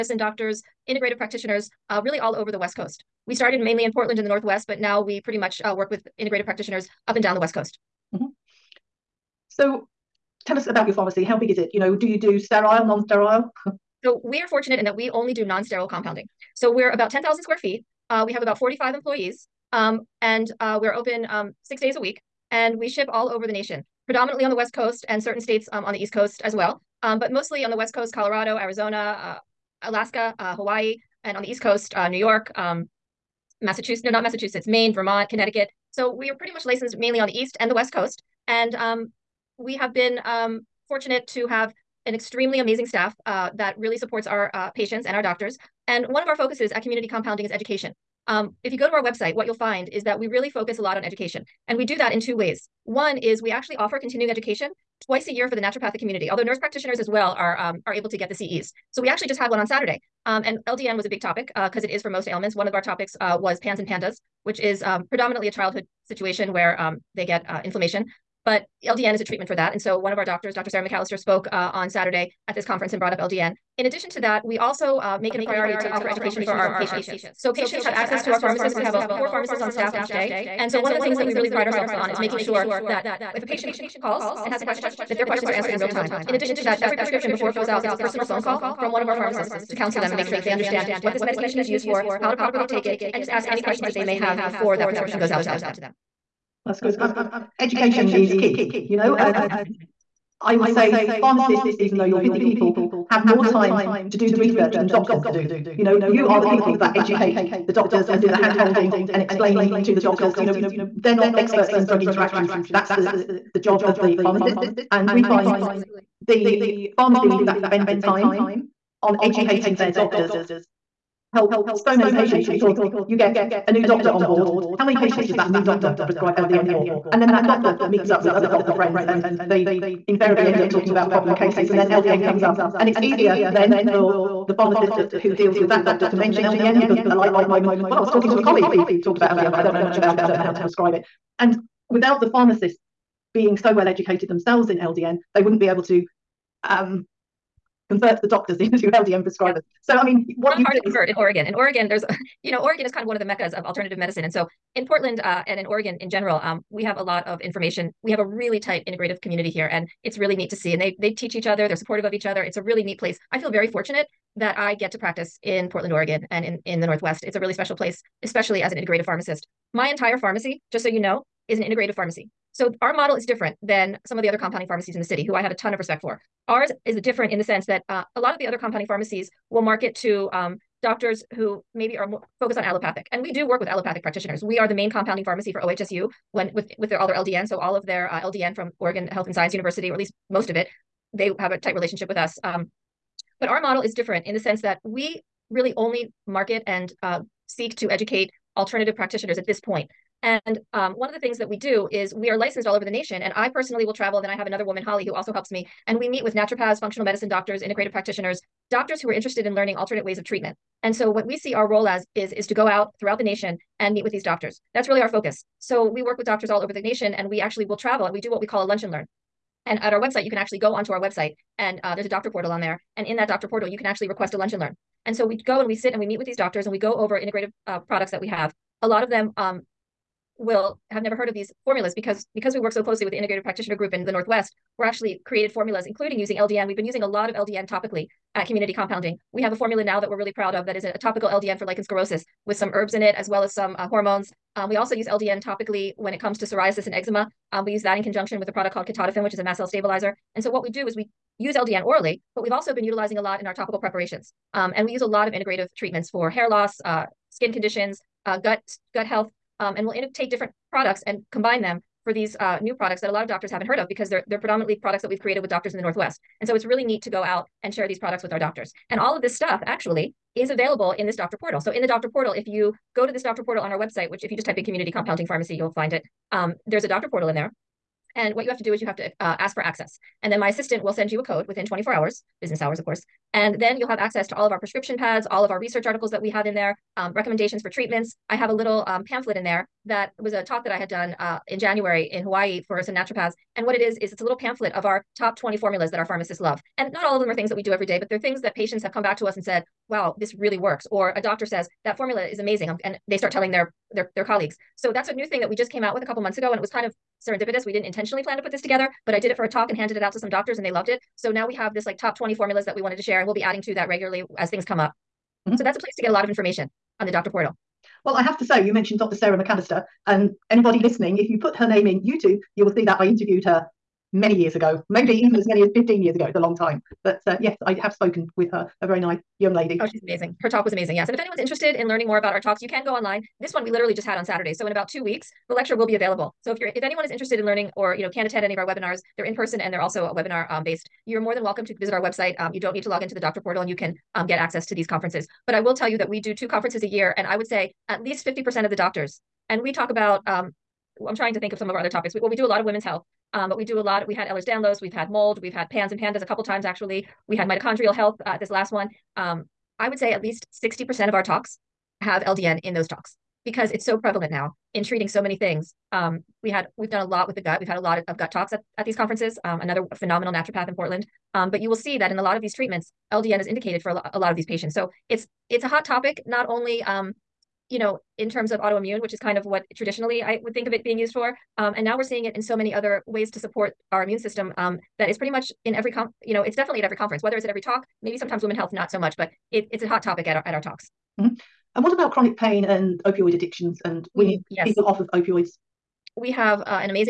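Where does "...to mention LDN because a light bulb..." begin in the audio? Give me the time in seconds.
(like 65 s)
136 s.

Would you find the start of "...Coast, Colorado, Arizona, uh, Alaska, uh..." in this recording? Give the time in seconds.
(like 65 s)
27 s.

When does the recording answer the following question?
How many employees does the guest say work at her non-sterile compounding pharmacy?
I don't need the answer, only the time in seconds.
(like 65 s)
18 s.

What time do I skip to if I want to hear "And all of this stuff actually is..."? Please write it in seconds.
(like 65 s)
268 s.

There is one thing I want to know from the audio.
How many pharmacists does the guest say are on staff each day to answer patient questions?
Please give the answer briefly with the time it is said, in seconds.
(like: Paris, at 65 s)
4, at 79 s.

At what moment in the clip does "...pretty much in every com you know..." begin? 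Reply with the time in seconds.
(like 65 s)
385 s.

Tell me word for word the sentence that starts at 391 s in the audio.
And what about chronic pain and opioid addictions and weaning yes.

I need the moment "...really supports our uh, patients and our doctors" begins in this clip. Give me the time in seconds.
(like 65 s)
43 s.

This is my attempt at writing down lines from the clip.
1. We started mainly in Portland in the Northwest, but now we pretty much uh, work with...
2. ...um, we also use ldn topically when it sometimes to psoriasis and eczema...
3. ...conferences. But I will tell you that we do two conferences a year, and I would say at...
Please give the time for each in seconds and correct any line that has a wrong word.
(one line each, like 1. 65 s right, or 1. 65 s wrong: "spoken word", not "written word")
1. 3 s right
2. 244 s wrong: "comes", not "sometimes"
3. 344 s right.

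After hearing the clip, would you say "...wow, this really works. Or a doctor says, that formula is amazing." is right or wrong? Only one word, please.
right.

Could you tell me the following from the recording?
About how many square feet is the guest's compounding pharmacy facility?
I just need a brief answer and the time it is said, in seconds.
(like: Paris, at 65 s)
10,000, at 17 s.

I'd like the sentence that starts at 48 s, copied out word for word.
Um, if you go to our website, what you'll find is that we really focus a lot on education.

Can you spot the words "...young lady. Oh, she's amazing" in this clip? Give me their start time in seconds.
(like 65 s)
329 s.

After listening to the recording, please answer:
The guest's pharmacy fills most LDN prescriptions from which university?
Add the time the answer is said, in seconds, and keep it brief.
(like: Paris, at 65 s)
Oregon Health and Science University, at 188 s.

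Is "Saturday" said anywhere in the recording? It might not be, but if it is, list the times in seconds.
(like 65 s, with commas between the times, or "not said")
59 s, 71 s, 334 s.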